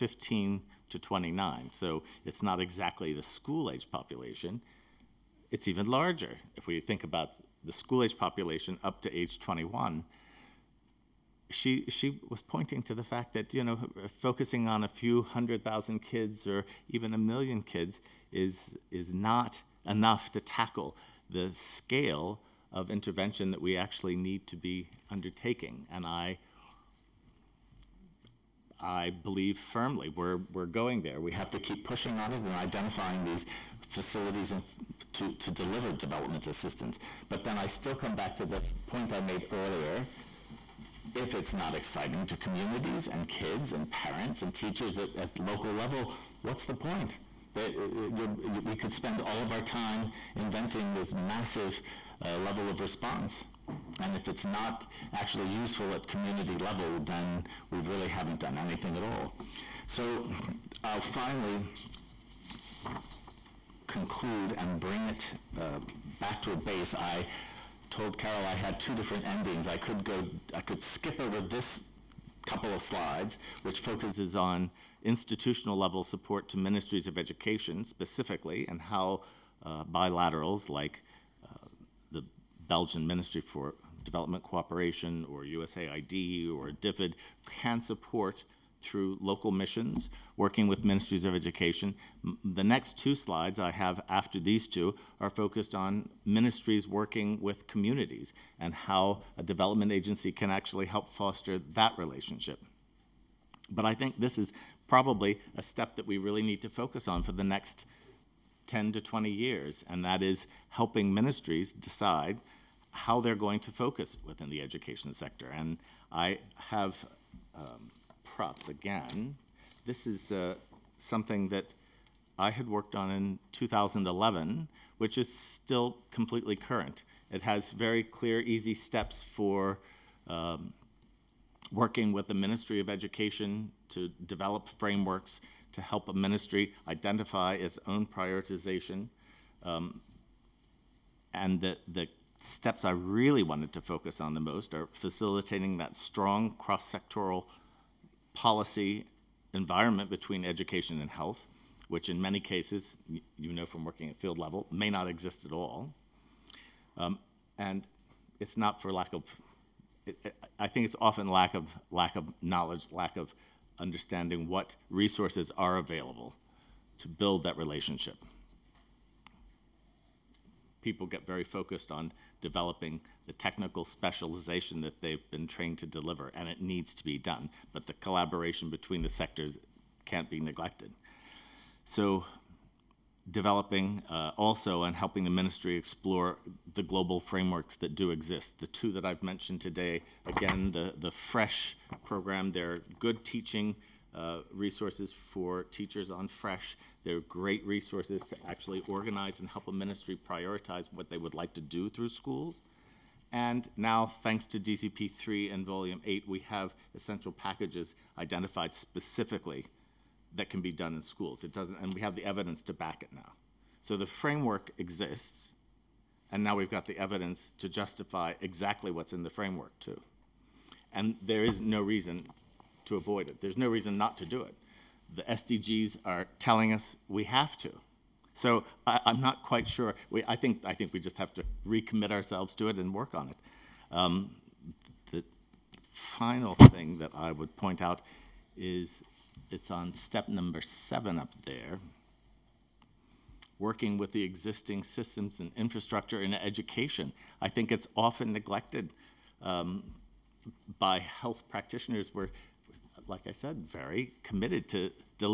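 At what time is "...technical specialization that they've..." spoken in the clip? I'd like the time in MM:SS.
02:53.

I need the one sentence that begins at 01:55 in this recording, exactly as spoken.
And I have um, props again.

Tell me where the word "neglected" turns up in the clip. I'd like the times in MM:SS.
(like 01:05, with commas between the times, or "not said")
03:00, 04:08.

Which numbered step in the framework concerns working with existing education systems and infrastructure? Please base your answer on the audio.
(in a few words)
7.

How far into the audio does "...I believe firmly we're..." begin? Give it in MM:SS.
00:28.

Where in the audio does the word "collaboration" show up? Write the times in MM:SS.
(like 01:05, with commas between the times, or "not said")
02:57.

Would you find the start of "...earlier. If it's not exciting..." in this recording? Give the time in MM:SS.
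00:39.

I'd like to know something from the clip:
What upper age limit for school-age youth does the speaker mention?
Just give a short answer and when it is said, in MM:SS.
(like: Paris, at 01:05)
21, at 00:09.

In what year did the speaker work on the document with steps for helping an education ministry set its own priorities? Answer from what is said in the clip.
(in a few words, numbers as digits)
2011.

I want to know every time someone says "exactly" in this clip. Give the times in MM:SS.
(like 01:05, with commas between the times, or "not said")
00:02, 03:38.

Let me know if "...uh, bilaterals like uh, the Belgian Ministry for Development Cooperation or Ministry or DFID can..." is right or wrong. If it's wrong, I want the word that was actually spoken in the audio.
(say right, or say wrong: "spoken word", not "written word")
wrong: "USAID", not "Ministry".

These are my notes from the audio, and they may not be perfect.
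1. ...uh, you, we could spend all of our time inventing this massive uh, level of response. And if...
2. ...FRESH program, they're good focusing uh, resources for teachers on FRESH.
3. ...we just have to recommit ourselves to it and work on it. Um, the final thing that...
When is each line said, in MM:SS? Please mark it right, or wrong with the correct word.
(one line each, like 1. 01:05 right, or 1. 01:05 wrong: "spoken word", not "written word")
1. 00:47 right
2. 03:11 wrong: "teaching", not "focusing"
3. 03:50 right.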